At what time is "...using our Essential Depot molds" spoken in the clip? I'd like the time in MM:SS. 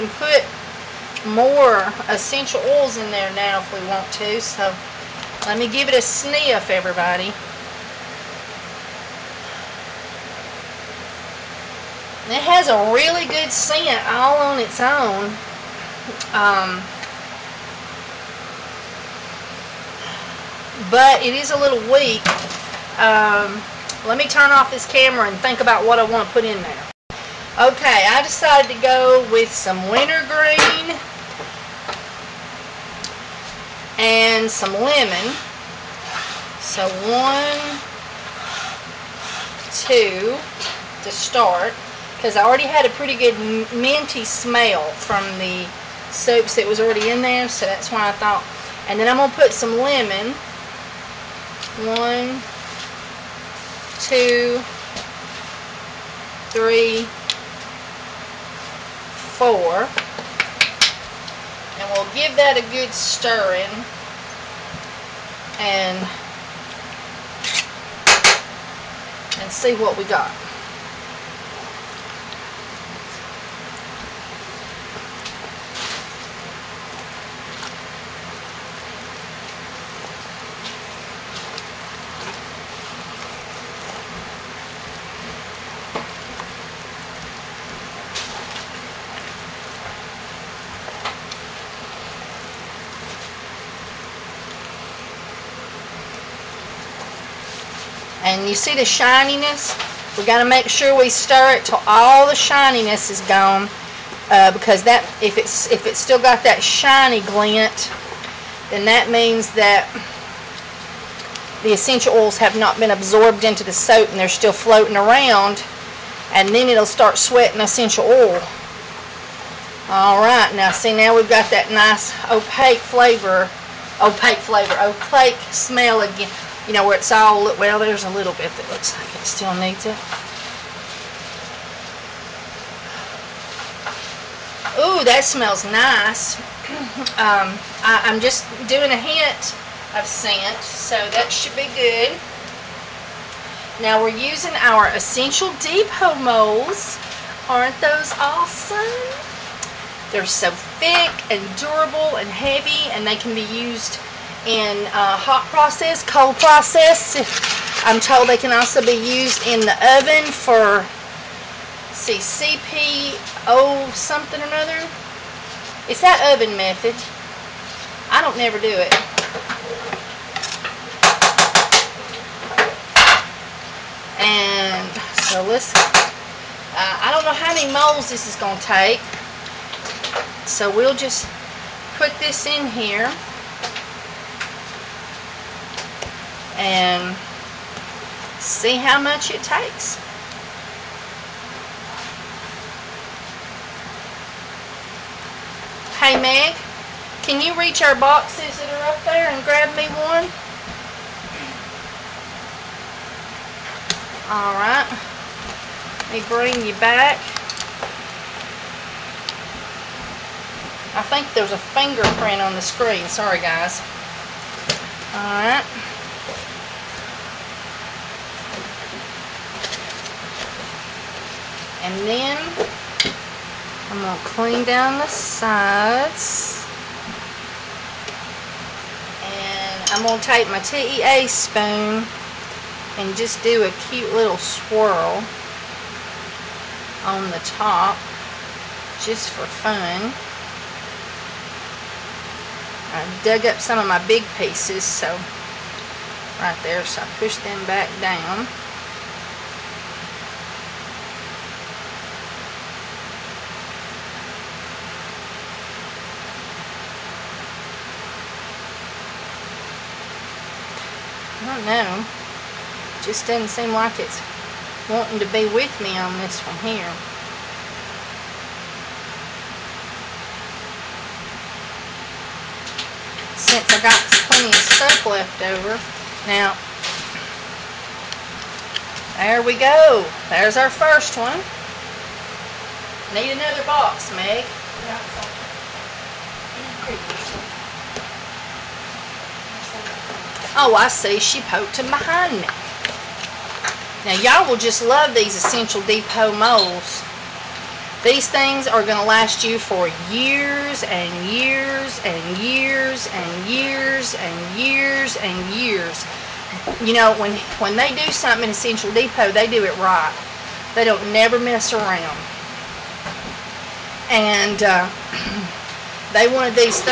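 02:24.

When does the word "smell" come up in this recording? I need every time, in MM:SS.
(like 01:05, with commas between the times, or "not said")
00:44, 02:05, 02:15.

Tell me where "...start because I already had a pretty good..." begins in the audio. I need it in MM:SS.
00:41.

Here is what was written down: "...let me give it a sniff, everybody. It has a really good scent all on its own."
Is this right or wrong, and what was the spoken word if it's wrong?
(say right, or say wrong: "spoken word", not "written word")
right.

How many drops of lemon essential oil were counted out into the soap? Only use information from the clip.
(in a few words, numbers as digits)
4.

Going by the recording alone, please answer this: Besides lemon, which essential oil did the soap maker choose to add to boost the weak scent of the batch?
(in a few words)
Wintergreen.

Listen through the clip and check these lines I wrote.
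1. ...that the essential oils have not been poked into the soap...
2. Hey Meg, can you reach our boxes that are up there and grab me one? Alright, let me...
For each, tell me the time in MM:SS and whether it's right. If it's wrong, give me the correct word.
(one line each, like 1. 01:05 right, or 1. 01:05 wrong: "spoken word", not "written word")
1. 01:49 wrong: "absorbed", not "poked"
2. 03:15 right.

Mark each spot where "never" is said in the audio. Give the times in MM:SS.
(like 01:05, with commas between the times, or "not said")
02:48, 05:11.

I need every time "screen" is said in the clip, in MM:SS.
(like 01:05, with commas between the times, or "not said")
03:32.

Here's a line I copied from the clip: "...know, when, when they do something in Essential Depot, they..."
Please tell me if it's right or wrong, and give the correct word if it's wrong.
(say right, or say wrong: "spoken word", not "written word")
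right.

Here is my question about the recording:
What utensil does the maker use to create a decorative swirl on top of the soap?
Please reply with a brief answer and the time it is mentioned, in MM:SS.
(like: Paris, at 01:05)
TEA spoon, at 03:50.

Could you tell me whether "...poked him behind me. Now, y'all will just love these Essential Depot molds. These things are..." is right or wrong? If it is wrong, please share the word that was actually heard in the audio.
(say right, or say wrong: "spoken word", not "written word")
right.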